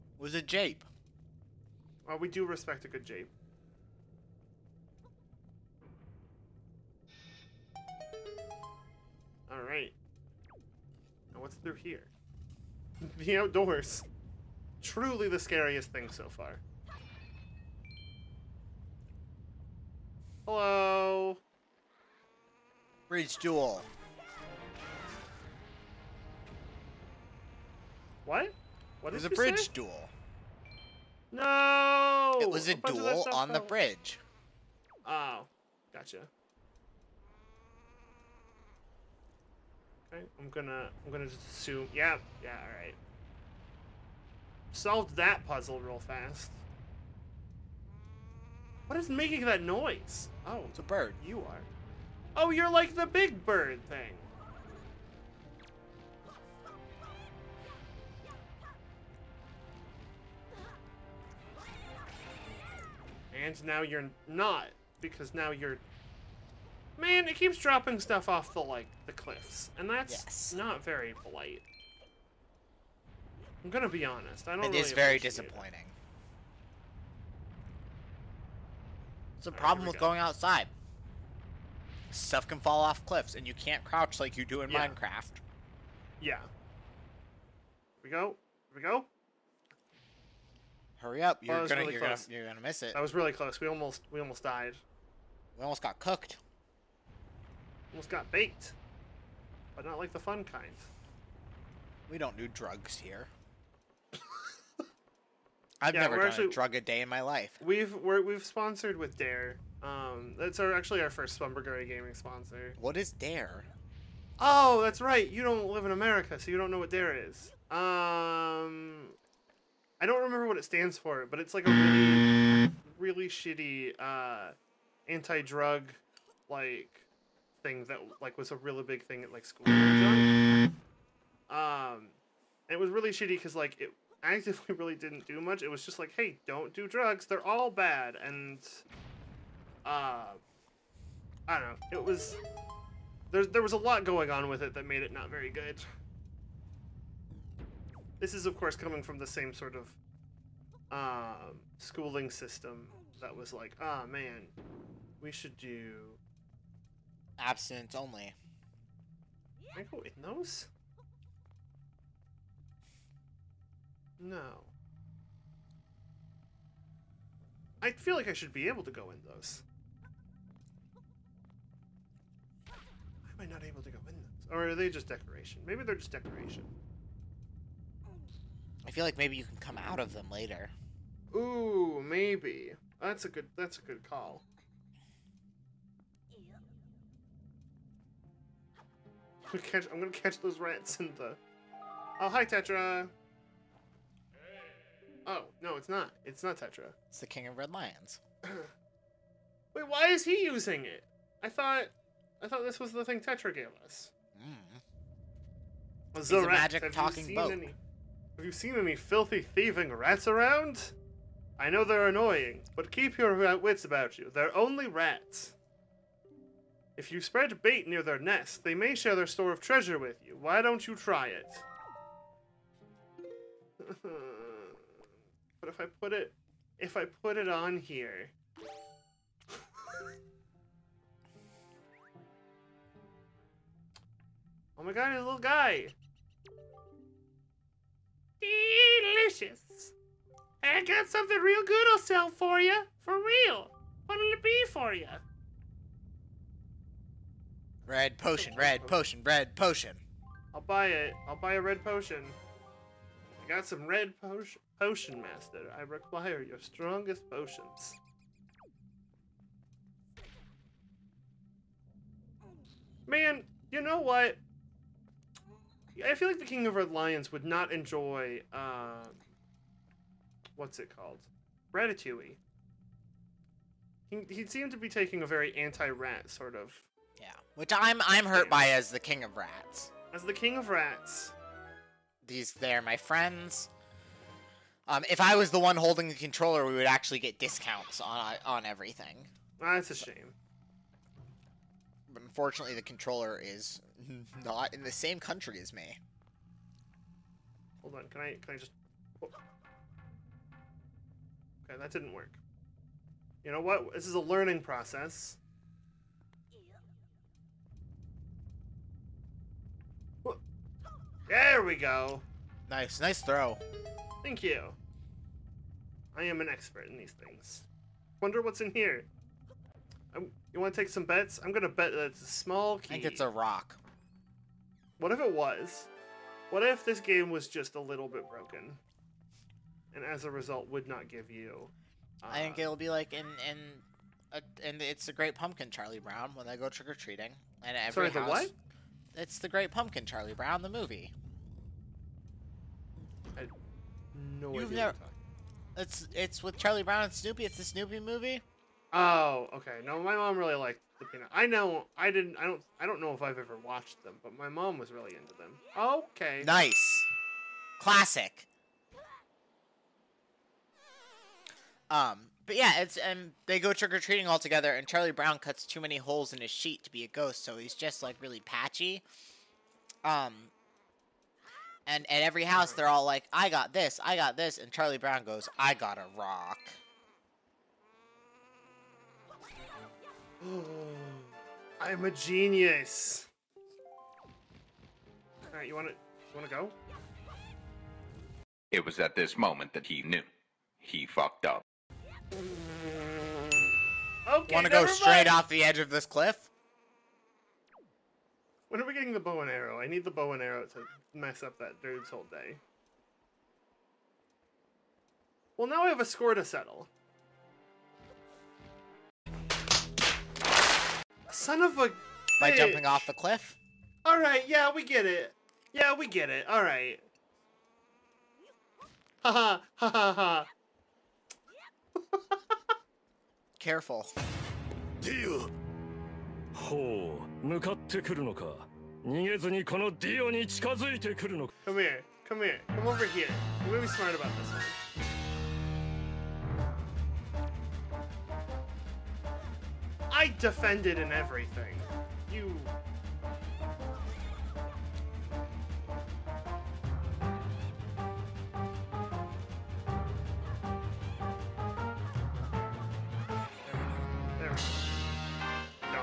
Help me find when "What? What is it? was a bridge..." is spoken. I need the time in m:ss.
0:28.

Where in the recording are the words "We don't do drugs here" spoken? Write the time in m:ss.
1:42.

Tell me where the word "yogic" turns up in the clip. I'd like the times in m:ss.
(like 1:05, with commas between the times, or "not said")
not said.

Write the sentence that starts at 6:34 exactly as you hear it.
Okay, want to go straight off the edge of this cliff?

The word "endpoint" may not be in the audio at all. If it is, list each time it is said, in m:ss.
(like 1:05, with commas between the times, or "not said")
not said.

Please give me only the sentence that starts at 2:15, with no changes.
It was just like, hey, don't do drugs.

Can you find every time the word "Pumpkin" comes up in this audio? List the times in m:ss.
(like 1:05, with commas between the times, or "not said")
5:35, 5:39.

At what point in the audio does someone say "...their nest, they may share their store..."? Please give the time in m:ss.
3:38.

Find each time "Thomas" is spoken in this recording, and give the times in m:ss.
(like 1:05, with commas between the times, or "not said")
not said.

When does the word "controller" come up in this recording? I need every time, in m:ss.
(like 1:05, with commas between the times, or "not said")
4:46, 4:52.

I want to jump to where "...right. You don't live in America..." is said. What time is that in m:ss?
1:55.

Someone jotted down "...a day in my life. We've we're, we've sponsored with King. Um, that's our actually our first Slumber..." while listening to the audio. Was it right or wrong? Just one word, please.
wrong.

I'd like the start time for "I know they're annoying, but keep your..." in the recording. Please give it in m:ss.
3:31.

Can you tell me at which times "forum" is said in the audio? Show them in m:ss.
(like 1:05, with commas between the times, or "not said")
not said.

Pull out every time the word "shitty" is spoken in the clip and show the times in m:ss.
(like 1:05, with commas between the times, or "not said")
2:03, 2:13.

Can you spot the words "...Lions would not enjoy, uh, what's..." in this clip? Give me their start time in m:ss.
4:26.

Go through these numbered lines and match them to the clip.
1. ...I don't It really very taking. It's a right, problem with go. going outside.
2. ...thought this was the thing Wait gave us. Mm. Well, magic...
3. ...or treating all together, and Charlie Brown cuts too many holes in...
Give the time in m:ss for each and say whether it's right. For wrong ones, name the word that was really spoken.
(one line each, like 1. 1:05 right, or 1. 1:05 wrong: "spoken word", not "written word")
1. 1:14 wrong: "disappointing", not "taking"
2. 3:22 wrong: "Tetra", not "Wait"
3. 6:03 right.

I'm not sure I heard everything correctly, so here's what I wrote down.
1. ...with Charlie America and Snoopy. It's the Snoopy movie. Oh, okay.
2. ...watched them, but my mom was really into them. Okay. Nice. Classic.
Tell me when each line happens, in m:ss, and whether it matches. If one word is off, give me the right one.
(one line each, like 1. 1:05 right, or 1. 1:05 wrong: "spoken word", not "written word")
1. 5:46 wrong: "Brown", not "America"
2. 5:53 right.